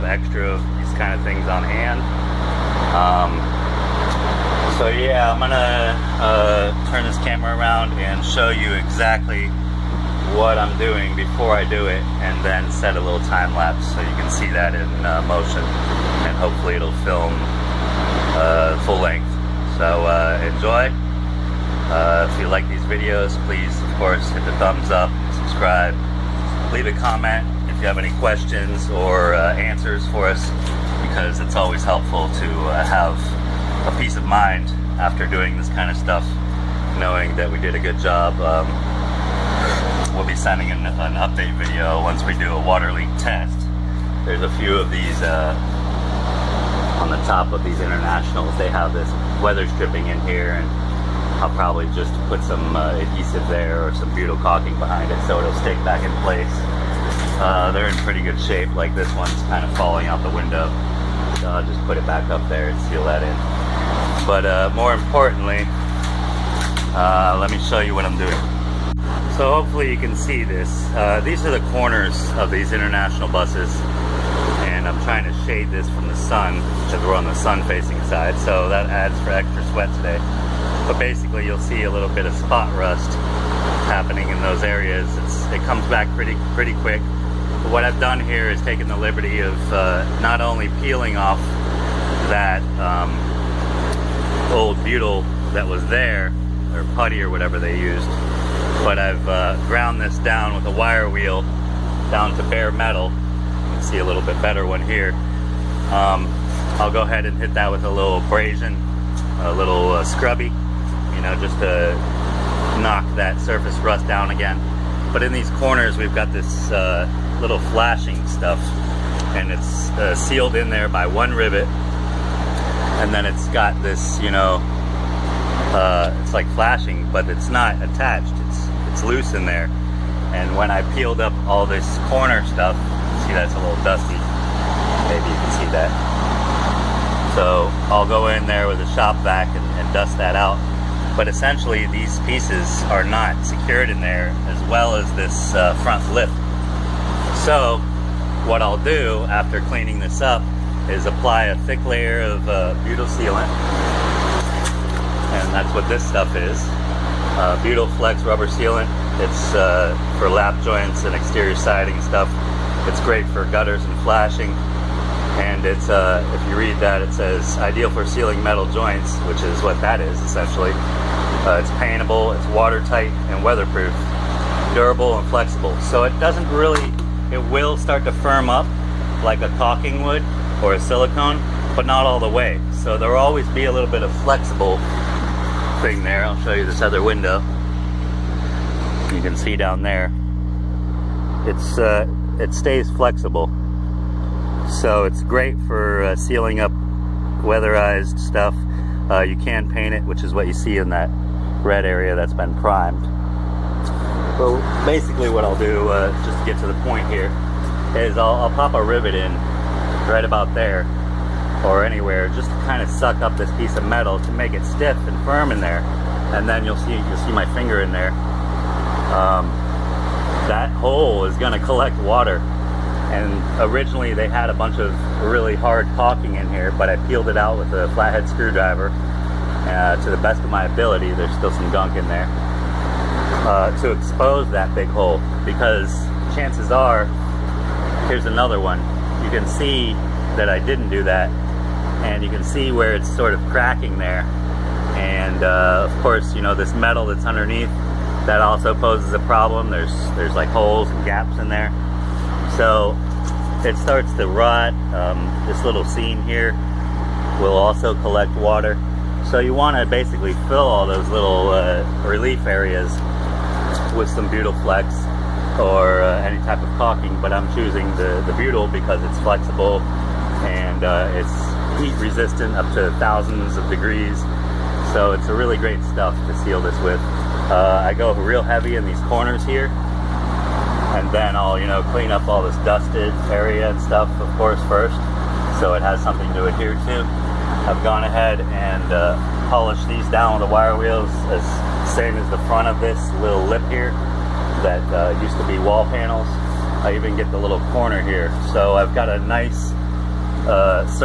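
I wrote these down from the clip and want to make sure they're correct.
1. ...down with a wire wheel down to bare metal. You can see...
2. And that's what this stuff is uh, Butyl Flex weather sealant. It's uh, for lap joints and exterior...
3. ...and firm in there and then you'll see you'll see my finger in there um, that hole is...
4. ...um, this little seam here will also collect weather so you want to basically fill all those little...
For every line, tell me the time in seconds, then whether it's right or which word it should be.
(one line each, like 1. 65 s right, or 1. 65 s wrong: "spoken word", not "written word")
1. 100 s right
2. 155 s wrong: "rubber", not "weather"
3. 215 s right
4. 254 s wrong: "water", not "weather".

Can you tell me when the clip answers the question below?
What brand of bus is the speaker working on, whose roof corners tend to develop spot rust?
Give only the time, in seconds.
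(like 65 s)
72 s.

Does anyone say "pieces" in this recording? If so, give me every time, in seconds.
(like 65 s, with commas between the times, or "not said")
142 s, 213 s.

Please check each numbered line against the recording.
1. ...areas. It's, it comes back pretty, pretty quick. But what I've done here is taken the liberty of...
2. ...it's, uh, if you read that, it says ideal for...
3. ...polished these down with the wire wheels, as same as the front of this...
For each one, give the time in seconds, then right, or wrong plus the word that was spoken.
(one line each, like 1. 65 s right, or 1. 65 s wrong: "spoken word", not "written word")
1. 84 s right
2. 165 s right
3. 289 s right.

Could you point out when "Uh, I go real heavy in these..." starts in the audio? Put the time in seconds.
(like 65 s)
277 s.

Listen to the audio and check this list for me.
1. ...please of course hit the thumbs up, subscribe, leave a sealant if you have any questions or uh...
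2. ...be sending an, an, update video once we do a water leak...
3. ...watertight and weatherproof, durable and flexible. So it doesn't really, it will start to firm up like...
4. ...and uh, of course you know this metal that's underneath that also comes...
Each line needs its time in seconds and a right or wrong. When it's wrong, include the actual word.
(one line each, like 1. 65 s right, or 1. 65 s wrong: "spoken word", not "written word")
1. 23 s wrong: "comment", not "sealant"
2. 40 s right
3. 172 s right
4. 244 s wrong: "poses", not "comes".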